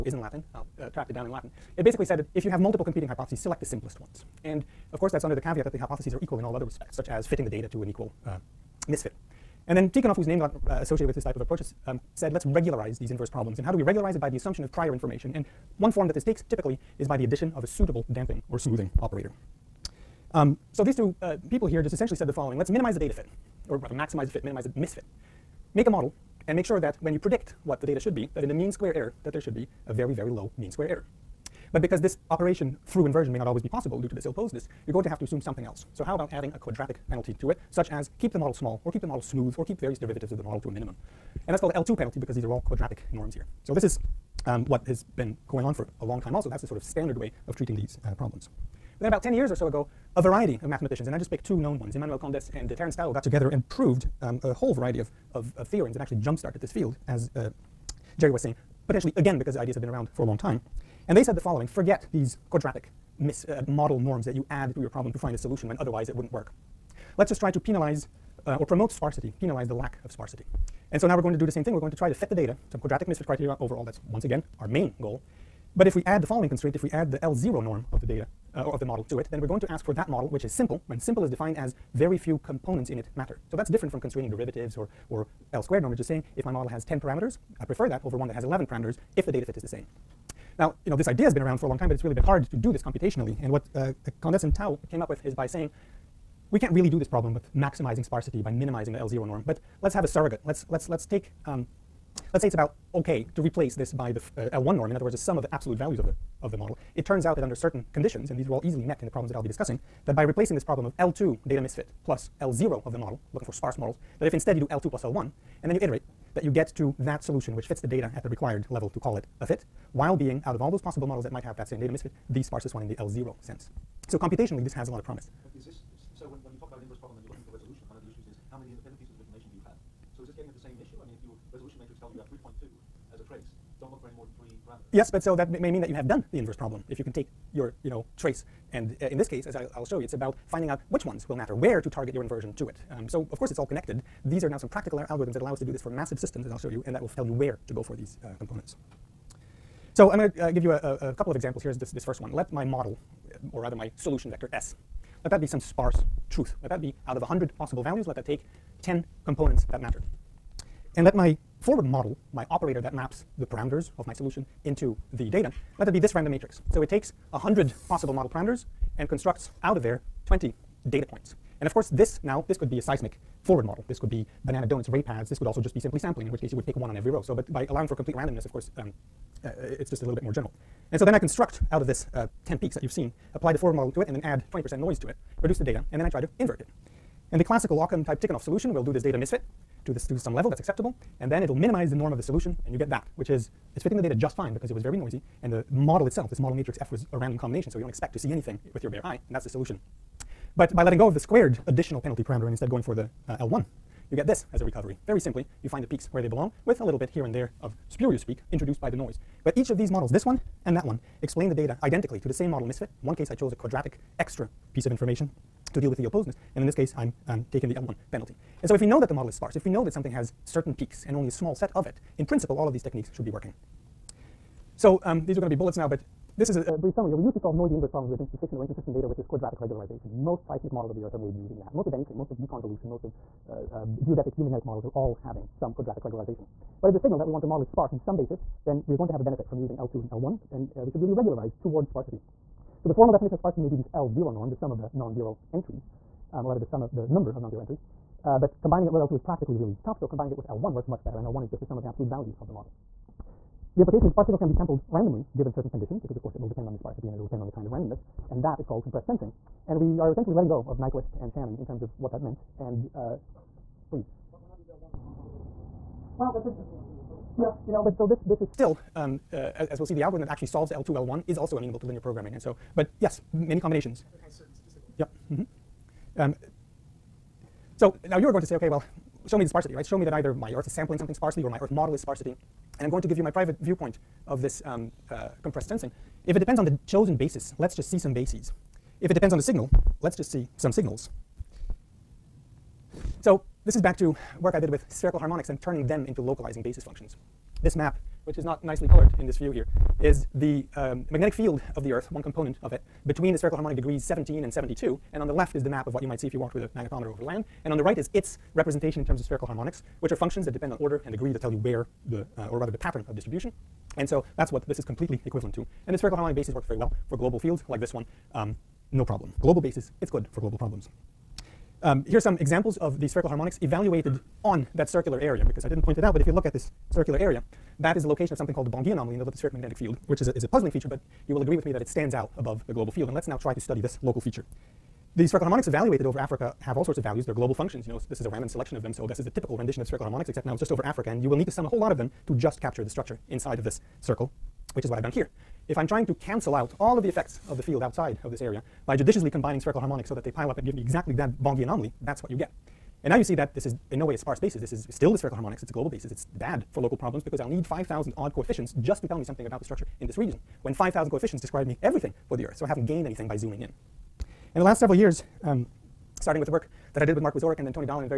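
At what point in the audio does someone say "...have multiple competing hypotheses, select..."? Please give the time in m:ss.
0:02.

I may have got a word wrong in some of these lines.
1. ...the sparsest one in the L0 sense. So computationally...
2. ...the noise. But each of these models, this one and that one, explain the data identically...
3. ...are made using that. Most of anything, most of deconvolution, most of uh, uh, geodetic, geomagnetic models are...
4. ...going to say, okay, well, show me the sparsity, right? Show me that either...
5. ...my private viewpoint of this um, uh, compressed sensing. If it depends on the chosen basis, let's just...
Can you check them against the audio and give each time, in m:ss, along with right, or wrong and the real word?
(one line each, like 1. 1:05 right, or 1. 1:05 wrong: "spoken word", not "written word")
1. 2:02 right
2. 3:28 right
3. 3:51 right
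4. 4:38 right
5. 4:43 right.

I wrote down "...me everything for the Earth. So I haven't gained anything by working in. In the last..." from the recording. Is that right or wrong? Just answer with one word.
wrong.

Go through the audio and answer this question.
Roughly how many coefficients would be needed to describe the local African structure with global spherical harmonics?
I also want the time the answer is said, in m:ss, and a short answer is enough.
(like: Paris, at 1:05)
5,000, at 5:57.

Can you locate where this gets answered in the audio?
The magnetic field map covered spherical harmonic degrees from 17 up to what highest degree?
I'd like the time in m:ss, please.
5:04.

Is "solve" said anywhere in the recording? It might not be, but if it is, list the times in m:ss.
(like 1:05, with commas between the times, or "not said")
3:47, 4:30.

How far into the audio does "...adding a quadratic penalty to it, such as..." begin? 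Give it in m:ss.
0:36.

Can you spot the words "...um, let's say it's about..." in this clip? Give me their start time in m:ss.
1:41.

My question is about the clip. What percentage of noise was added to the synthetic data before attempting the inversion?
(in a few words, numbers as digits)
20%.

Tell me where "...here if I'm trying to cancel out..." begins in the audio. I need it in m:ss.
5:45.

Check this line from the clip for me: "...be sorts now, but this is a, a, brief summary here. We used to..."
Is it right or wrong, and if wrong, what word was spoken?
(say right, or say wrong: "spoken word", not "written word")
wrong: "bullets", not "sorts".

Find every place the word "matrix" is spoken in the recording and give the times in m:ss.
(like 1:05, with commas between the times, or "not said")
2:46, 3:16.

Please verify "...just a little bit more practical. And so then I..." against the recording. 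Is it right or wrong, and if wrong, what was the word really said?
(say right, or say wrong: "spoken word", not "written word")
wrong: "general", not "practical".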